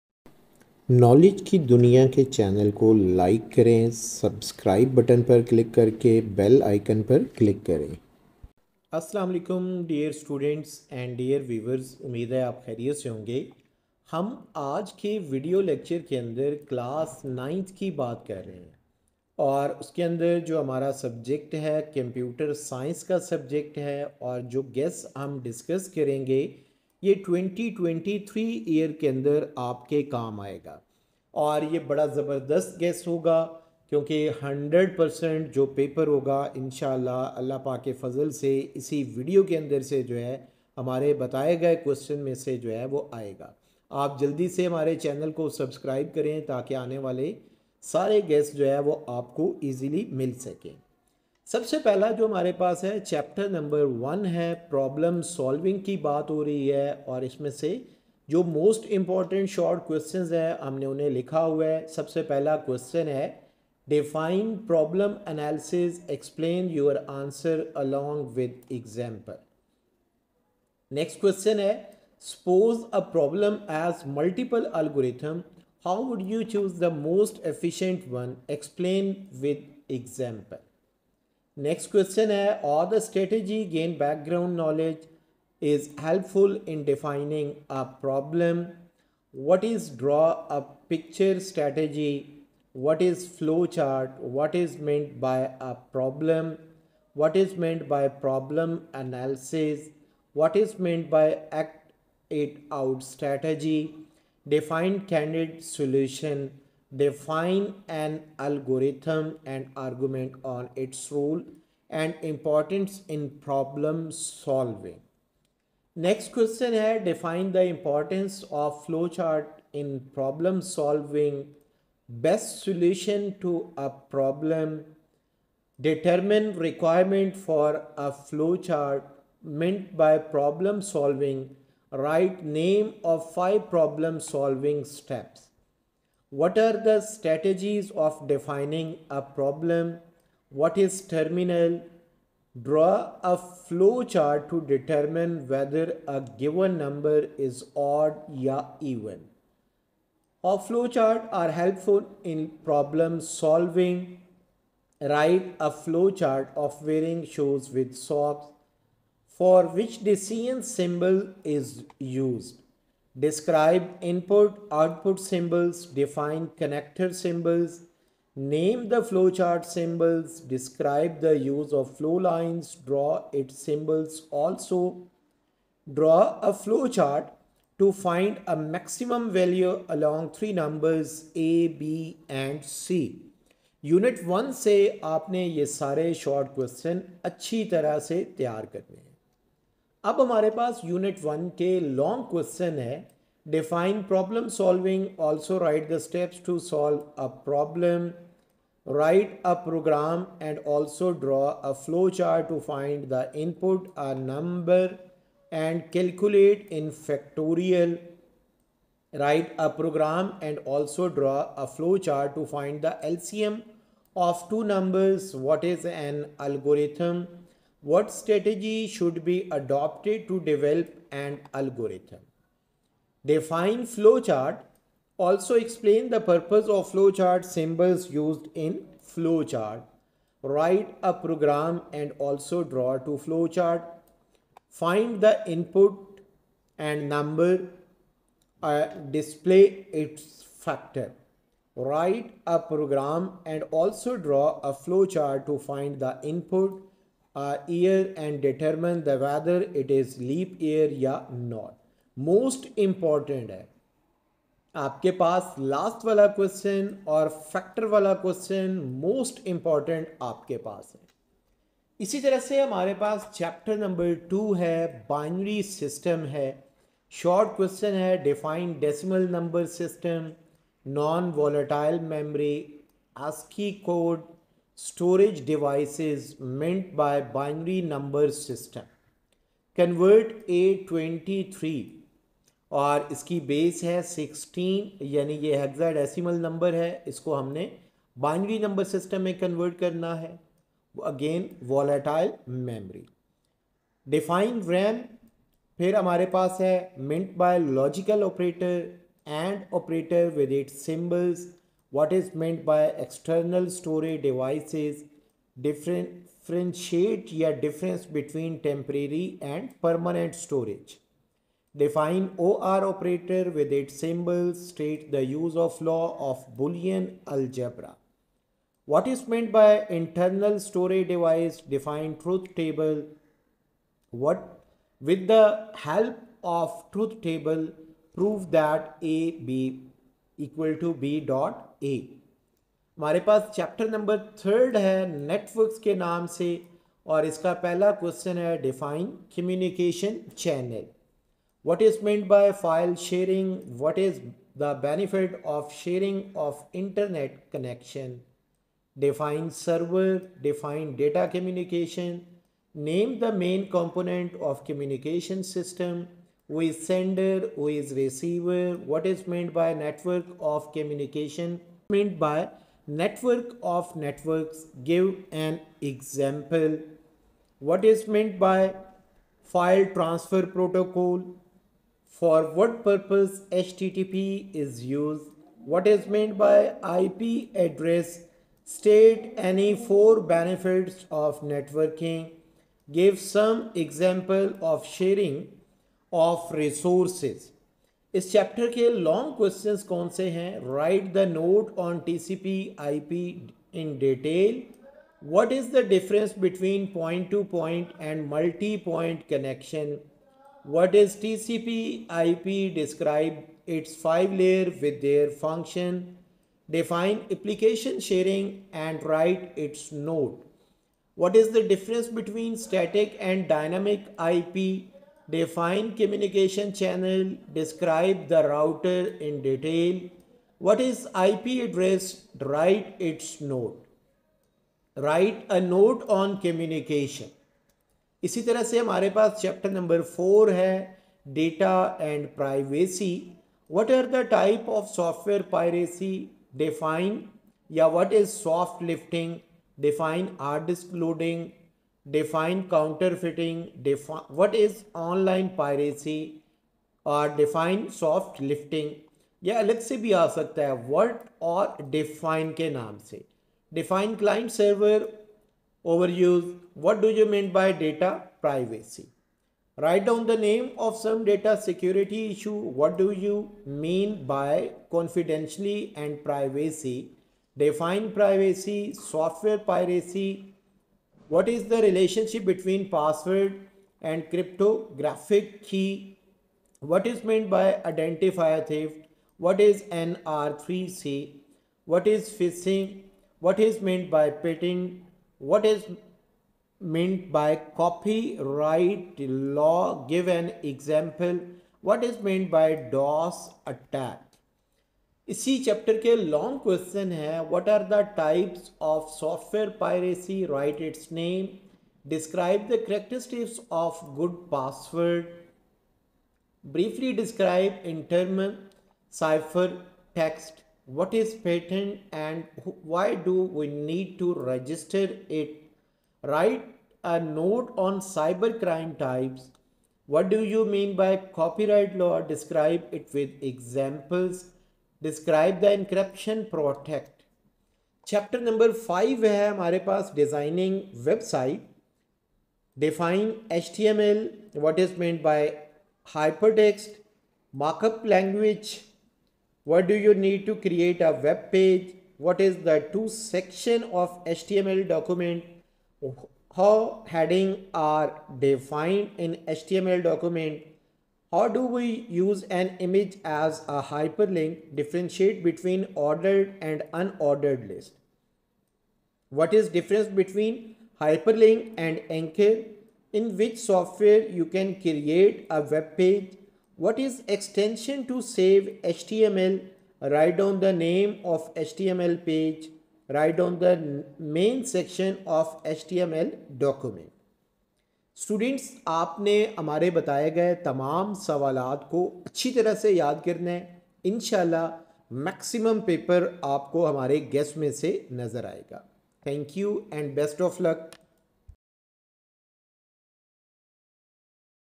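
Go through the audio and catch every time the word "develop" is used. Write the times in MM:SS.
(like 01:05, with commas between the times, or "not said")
03:40.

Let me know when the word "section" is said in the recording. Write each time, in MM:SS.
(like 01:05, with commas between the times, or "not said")
09:03, 09:34.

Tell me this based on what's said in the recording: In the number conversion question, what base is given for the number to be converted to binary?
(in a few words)
16.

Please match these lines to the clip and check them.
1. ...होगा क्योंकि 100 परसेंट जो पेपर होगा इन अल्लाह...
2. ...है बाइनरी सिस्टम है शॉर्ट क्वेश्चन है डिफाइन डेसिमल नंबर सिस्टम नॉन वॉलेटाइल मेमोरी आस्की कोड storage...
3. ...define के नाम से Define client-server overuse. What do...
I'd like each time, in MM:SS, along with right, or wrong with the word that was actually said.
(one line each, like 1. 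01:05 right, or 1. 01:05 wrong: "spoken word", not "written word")
1. 00:33 right
2. 04:24 right
3. 07:31 right.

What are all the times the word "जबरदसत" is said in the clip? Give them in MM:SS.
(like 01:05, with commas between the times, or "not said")
00:32.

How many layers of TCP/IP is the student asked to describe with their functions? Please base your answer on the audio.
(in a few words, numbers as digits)
5.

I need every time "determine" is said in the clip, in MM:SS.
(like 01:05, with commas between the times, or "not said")
02:05, 02:24.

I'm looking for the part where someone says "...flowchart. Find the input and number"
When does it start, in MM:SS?
03:53.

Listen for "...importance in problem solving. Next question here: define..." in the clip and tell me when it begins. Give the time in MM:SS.
01:52.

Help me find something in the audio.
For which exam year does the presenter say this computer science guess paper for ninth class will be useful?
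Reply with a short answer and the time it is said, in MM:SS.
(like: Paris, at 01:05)
2023, at 00:27.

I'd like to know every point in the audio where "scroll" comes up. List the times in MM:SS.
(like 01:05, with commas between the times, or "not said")
not said.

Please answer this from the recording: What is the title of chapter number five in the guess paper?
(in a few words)
Designing website.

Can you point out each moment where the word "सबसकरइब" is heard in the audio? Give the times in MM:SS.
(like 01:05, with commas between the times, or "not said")
00:03, 00:45.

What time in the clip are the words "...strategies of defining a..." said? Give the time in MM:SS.
02:17.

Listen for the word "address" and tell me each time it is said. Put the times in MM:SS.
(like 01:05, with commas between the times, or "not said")
06:17, 07:01.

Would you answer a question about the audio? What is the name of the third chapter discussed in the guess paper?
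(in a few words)
Networks.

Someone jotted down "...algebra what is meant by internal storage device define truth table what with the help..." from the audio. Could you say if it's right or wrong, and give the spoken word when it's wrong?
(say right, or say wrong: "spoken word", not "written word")
right.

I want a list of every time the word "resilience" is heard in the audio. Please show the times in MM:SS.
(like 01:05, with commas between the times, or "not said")
not said.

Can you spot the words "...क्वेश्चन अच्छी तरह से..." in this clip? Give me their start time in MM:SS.
03:06.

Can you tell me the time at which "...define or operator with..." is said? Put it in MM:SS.
05:11.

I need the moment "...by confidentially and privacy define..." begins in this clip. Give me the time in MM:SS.
07:44.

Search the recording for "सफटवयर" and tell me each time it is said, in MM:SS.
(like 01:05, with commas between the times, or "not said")
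07:14, 08:19.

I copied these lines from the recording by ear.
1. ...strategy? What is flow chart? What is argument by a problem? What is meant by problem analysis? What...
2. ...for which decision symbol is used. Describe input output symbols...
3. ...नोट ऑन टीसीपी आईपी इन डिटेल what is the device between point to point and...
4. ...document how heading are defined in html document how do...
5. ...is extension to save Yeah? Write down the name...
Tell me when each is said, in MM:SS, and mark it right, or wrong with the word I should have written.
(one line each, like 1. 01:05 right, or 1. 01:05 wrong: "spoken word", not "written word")
1. 01:31 wrong: "meant", not "argument"
2. 02:39 right
3. 06:31 wrong: "difference", not "device"
4. 09:04 right
5. 09:26 wrong: "HTML", not "Yeah".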